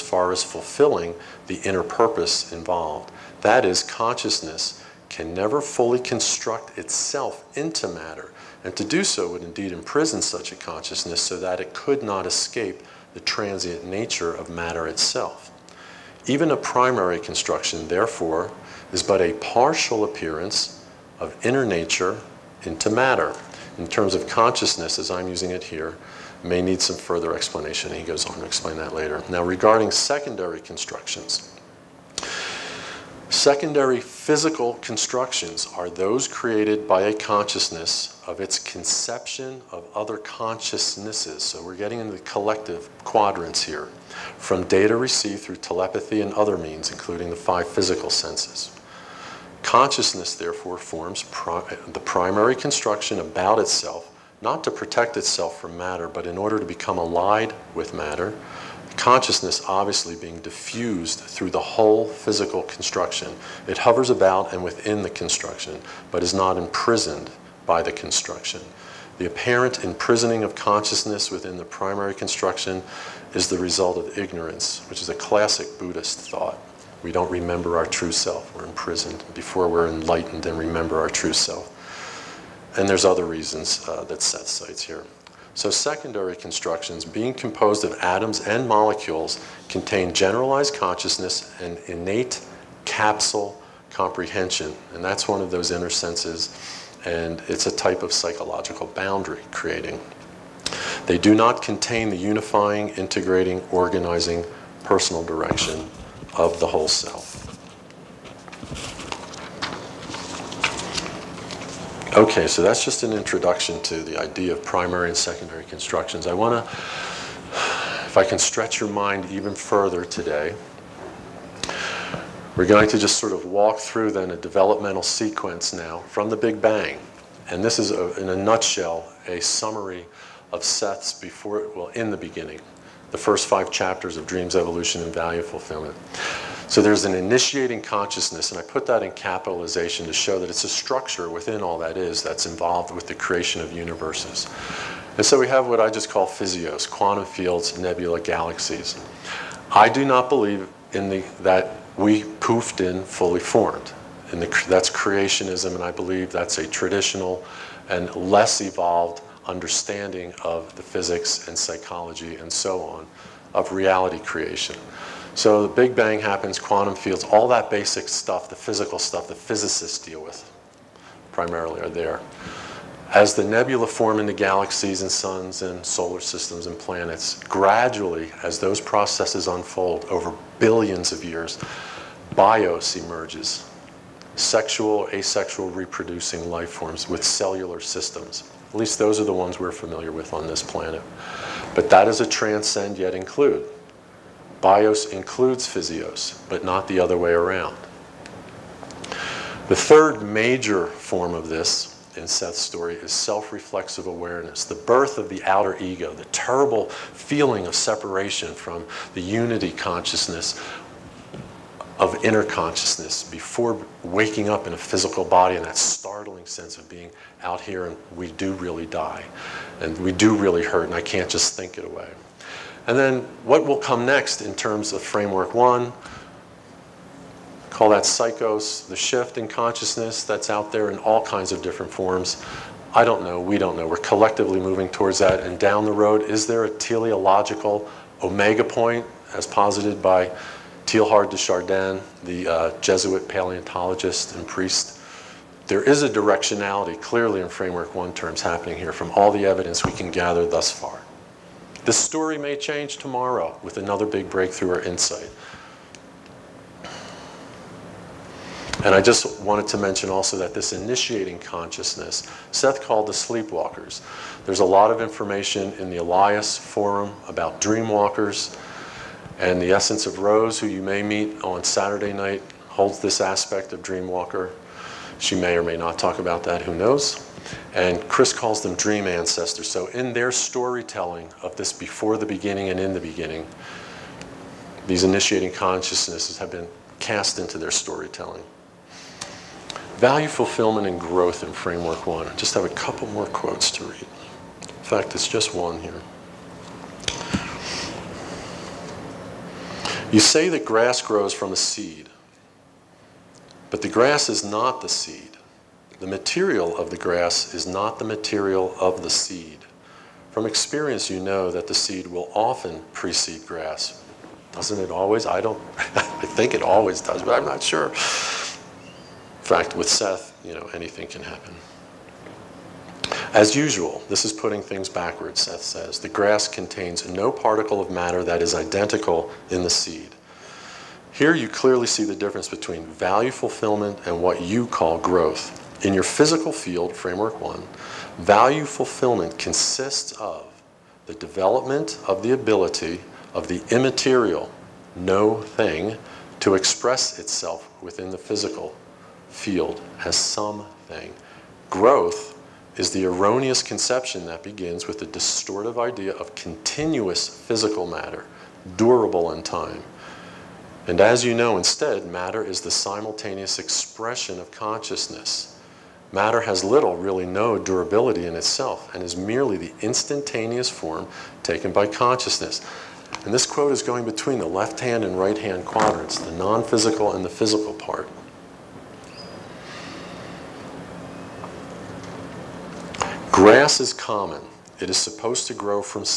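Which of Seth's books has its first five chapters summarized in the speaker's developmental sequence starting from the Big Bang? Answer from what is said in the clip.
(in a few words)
Dreams, Evolution, and Value Fulfillment.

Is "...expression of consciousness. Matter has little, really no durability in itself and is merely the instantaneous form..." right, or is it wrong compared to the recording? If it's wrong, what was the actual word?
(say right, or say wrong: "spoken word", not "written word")
right.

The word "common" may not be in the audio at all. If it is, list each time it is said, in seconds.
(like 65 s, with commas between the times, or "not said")
383 s.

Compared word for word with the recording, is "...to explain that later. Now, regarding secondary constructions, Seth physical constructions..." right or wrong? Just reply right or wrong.
wrong.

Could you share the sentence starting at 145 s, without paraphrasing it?
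And so we have what I just call physios, quantum fields, nebula, galaxies.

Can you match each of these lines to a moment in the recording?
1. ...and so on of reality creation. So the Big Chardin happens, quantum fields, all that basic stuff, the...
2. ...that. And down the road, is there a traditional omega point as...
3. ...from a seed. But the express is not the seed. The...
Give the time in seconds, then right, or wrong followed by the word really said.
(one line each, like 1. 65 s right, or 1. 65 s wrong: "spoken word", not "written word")
1. 162 s wrong: "Bang", not "Chardin"
2. 235 s wrong: "teleological", not "traditional"
3. 301 s wrong: "grass", not "express".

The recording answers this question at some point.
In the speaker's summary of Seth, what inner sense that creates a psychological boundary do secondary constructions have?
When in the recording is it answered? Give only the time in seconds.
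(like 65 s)
91 s.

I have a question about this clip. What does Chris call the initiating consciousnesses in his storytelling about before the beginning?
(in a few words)
dream ancestors.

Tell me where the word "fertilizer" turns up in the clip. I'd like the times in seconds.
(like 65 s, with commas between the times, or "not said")
not said.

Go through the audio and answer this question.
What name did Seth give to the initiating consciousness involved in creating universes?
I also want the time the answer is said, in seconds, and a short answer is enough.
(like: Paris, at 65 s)
the sleepwalkers, at 263 s.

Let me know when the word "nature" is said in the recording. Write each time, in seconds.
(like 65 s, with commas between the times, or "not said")
13 s, 21 s.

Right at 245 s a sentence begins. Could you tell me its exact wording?
There is a directionality clearly in framework one terms happening here from all the evidence we can gather thus far.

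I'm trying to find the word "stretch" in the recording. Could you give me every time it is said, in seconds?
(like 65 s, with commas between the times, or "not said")
118 s.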